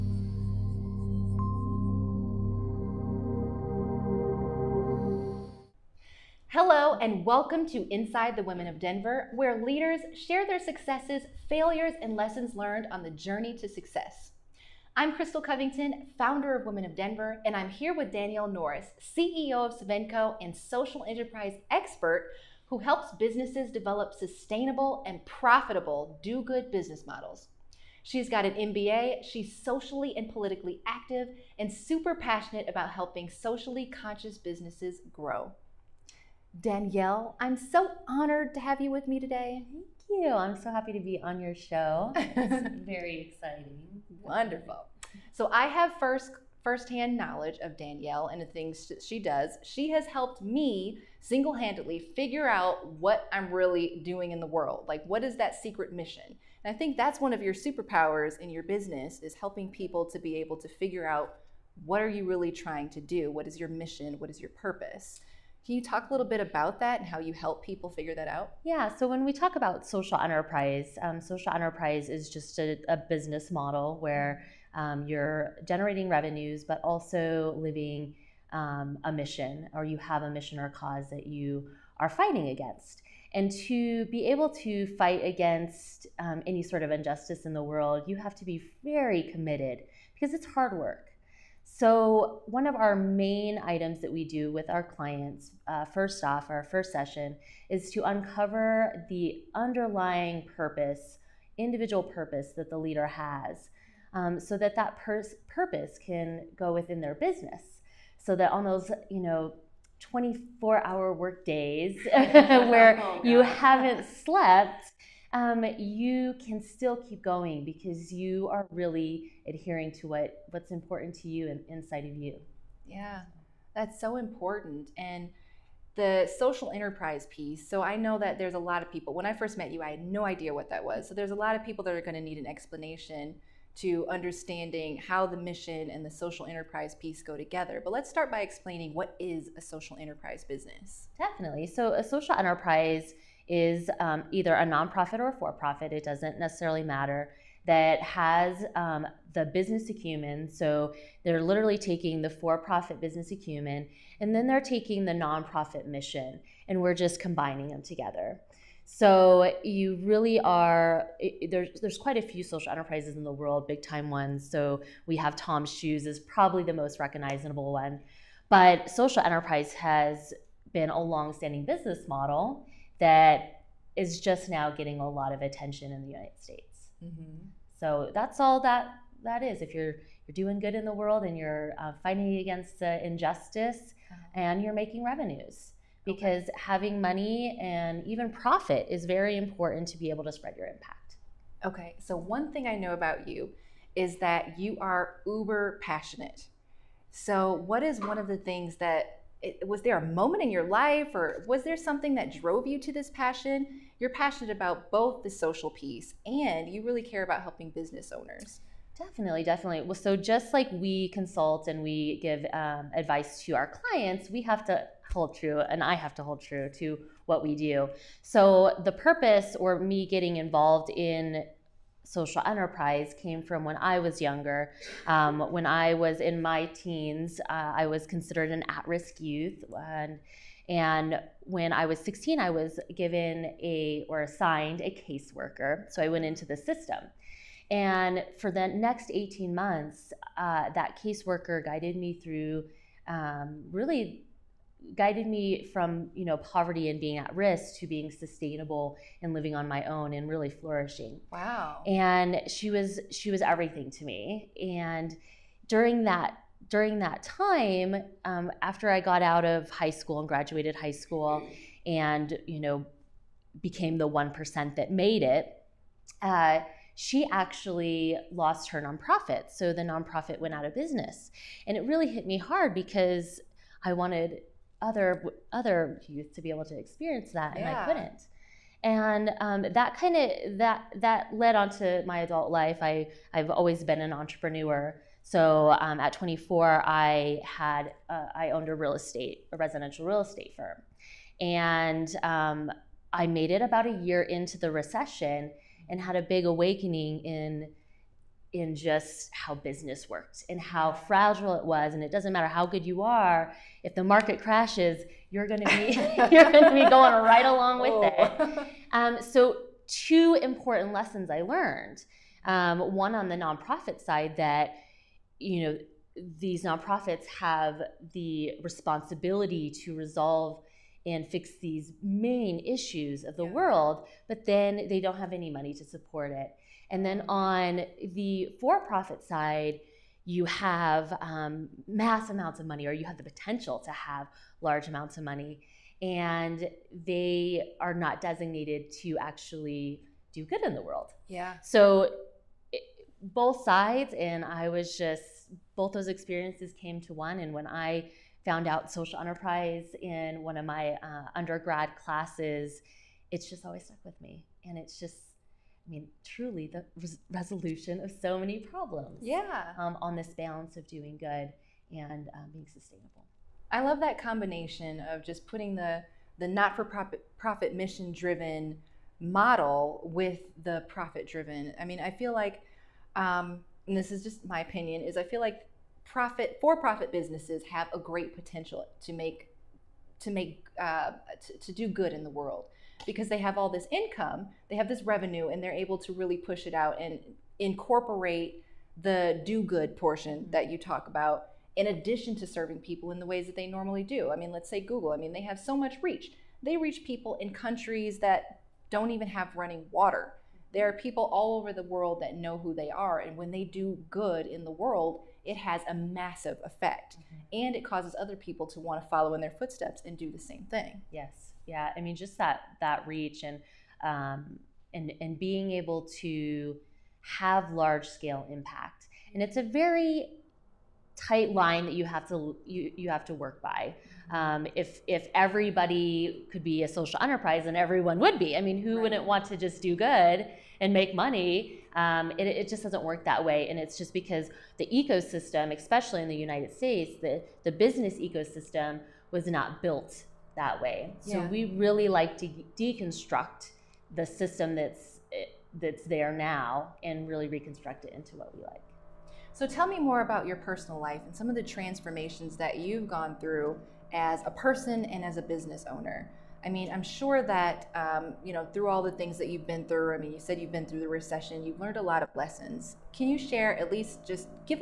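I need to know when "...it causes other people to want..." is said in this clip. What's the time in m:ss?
6:47.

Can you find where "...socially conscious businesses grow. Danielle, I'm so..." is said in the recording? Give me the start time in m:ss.
0:33.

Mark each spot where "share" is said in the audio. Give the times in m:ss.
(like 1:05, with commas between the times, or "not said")
0:10, 7:43.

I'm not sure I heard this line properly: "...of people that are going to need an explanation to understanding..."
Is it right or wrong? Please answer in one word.
right.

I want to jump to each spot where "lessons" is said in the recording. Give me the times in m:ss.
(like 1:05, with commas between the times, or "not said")
0:12, 5:10, 7:42.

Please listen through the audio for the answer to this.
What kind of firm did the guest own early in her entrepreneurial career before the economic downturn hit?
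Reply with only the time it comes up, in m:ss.
4:49.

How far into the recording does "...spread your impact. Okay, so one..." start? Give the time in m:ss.
3:10.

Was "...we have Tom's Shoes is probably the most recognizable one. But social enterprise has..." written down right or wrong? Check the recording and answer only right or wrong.
right.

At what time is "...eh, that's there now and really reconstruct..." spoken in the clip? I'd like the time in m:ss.
7:25.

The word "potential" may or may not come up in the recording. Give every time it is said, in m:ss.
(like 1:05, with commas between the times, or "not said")
5:33, 6:18.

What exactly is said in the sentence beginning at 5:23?
world, but then they don't have any money to support it.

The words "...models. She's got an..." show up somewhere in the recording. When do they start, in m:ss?
0:27.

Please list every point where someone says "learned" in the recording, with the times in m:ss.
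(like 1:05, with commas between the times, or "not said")
0:12, 5:11, 7:41.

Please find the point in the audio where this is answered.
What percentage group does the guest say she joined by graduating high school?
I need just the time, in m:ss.
4:24.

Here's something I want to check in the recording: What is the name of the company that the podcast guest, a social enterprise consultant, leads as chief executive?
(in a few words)
Sovenco.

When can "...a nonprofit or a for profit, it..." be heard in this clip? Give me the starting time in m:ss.
2:24.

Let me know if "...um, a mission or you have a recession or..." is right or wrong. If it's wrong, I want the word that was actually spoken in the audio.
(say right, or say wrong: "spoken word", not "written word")
wrong: "mission", not "recession".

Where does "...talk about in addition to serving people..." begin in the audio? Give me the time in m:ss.
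6:30.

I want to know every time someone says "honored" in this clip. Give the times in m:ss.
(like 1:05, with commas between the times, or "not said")
0:38.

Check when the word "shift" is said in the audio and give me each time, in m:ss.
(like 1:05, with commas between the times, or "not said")
not said.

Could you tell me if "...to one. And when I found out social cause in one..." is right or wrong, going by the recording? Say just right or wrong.
wrong.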